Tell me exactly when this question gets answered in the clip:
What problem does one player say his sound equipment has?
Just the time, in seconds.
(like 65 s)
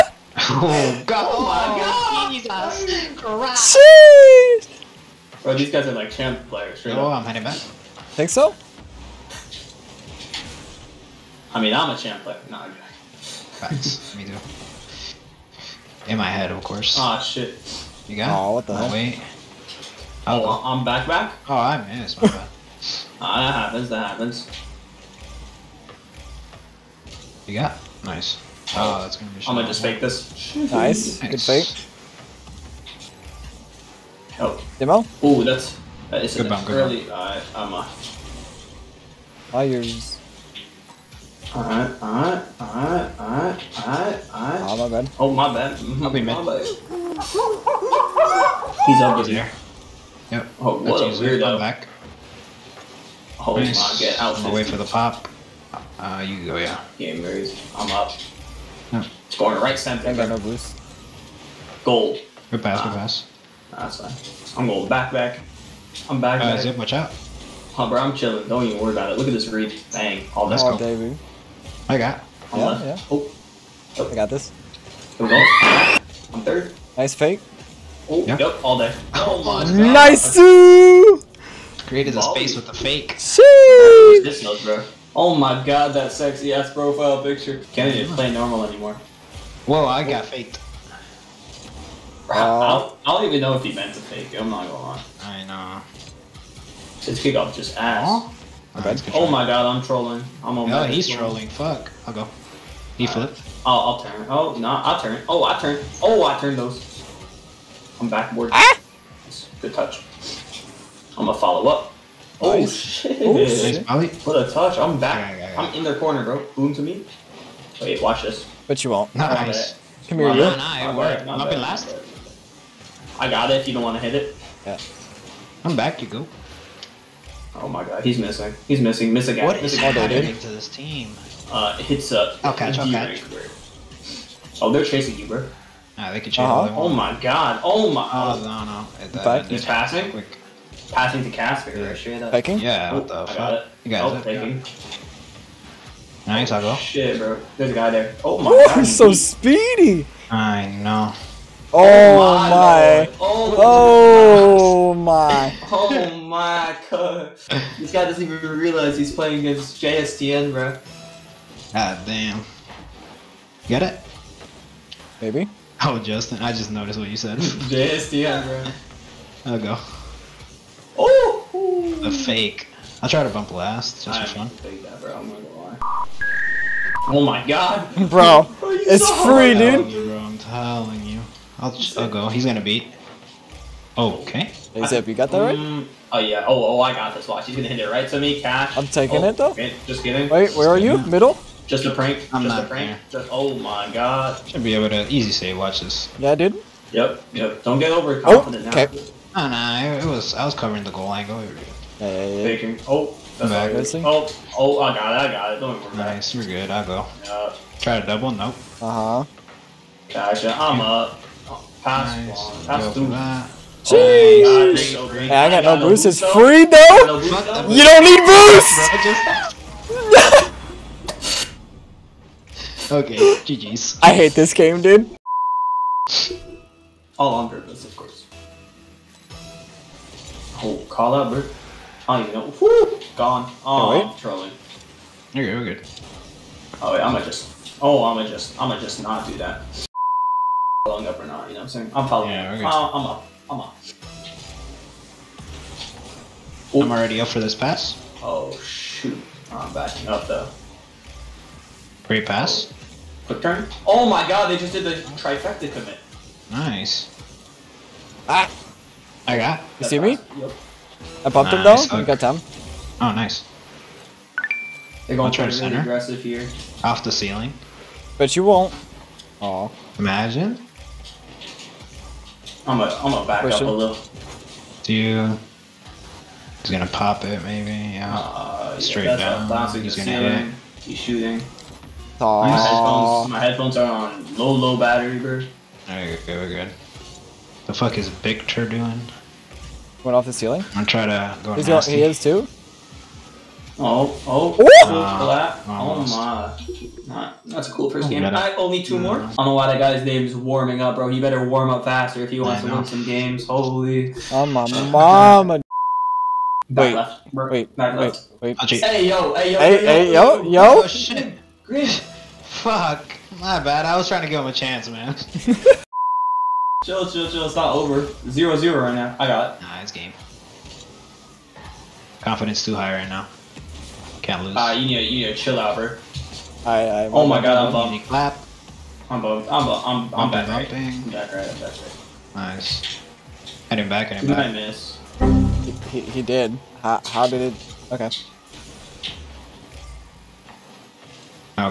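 284 s.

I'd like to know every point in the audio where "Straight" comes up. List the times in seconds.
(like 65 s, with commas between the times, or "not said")
141 s, 278 s.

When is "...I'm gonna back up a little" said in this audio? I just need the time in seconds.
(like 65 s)
272 s.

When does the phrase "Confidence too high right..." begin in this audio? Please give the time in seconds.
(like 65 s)
322 s.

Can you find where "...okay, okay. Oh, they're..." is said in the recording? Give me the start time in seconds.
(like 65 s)
132 s.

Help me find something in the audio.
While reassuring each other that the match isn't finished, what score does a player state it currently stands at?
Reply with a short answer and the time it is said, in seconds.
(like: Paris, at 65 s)
0-0, at 318 s.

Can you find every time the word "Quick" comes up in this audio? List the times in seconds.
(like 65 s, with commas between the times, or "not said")
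140 s, 253 s.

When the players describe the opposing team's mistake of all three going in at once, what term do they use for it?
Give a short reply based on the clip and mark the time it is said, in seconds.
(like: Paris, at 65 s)
trifecta commit, at 255 s.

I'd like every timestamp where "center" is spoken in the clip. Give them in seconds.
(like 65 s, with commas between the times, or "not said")
59 s, 265 s.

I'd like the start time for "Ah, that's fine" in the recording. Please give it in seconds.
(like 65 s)
63 s.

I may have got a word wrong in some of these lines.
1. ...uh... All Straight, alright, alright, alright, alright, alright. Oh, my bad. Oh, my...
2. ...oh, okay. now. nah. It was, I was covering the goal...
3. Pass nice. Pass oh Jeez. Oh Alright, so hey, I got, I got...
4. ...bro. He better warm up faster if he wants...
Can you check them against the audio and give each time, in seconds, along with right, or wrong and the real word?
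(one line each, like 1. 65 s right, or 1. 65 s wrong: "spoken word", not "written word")
1. 37 s wrong: "Alright", not "Straight"
2. 198 s right
3. 211 s wrong: "God", not "Alright"
4. 300 s right.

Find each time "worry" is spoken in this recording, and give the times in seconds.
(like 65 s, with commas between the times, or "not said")
68 s, 205 s.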